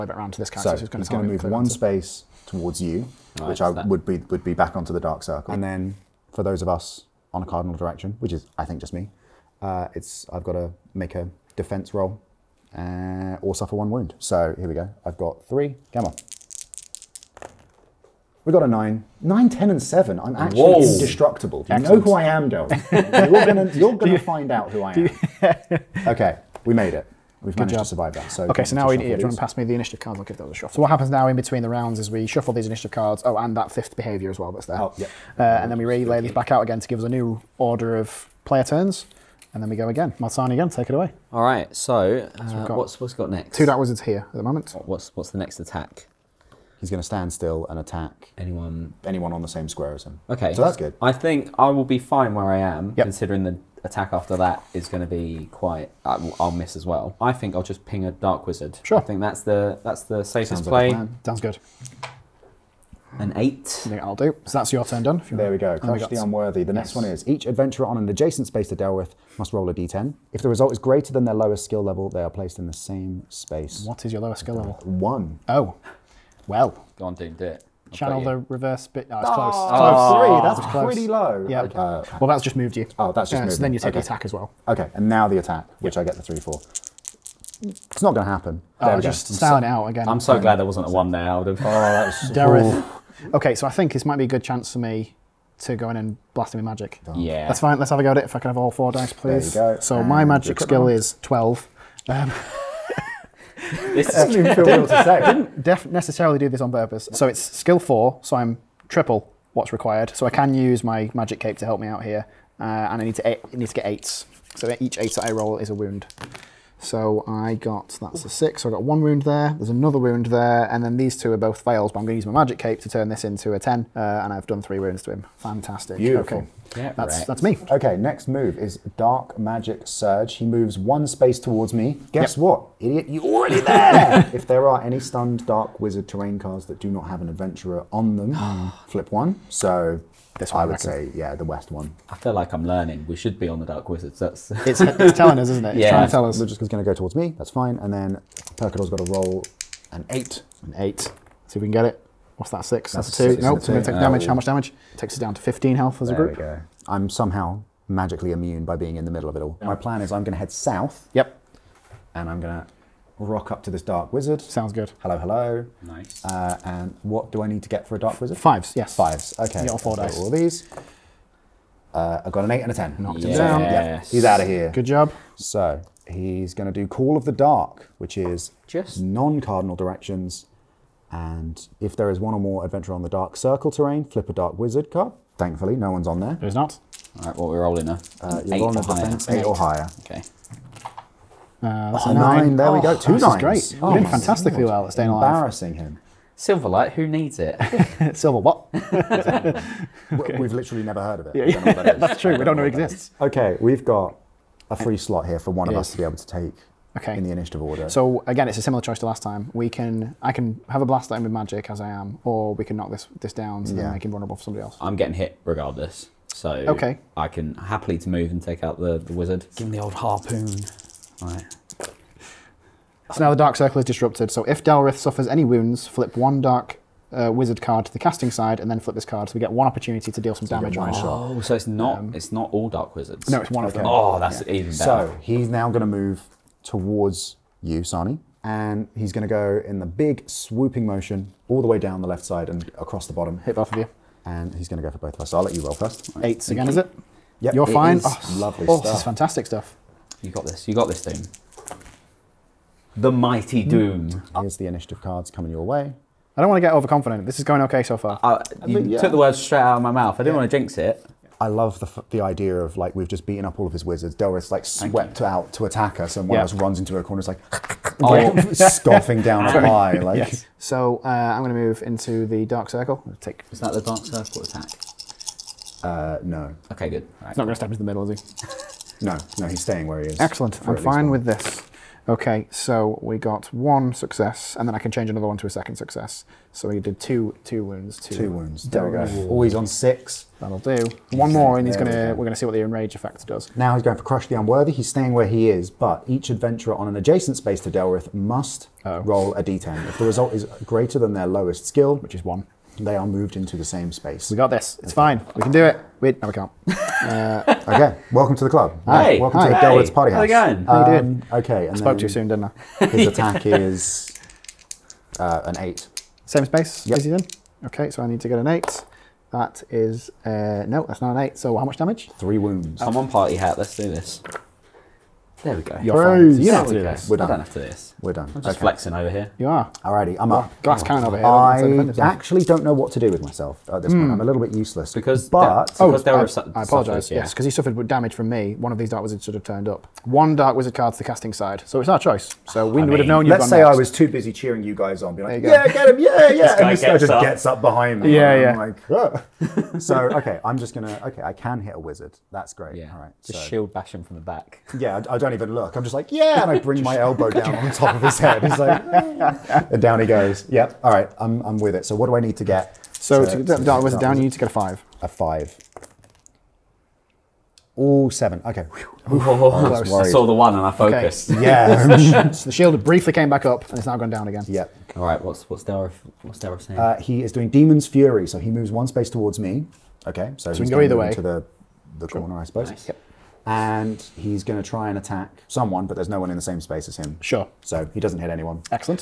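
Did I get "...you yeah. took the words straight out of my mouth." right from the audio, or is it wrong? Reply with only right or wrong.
right.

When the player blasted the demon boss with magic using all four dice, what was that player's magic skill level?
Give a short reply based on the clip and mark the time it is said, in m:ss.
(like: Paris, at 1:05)
12, at 1:40.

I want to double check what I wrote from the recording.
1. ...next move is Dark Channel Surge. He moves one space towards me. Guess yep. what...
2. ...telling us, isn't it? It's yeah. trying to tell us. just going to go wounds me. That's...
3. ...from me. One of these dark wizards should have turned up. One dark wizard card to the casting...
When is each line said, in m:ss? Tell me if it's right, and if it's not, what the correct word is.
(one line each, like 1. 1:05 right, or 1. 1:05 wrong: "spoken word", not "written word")
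1. 2:07 wrong: "Magic", not "Channel"
2. 2:25 wrong: "towards", not "wounds"
3. 5:38 right.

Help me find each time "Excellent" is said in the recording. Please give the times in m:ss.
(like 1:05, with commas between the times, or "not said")
0:21, 4:40.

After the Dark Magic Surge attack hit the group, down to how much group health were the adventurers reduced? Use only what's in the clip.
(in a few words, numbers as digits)
15.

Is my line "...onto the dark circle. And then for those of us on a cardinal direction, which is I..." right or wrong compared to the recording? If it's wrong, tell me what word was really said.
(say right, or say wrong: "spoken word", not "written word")
right.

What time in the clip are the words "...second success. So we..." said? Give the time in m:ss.
4:45.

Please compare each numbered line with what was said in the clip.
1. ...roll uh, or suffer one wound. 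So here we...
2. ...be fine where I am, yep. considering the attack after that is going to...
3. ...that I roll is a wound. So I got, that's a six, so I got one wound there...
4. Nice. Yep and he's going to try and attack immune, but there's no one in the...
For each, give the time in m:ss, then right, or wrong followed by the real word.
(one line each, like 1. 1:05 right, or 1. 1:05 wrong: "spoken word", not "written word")
1. 0:11 right
2. 0:51 right
3. 1:55 right
4. 6:22 wrong: "someone", not "immune".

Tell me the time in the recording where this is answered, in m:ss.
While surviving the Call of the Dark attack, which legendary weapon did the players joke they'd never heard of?
3:16.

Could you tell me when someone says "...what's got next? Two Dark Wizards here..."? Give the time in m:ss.
0:43.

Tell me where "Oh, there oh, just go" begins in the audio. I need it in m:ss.
1:28.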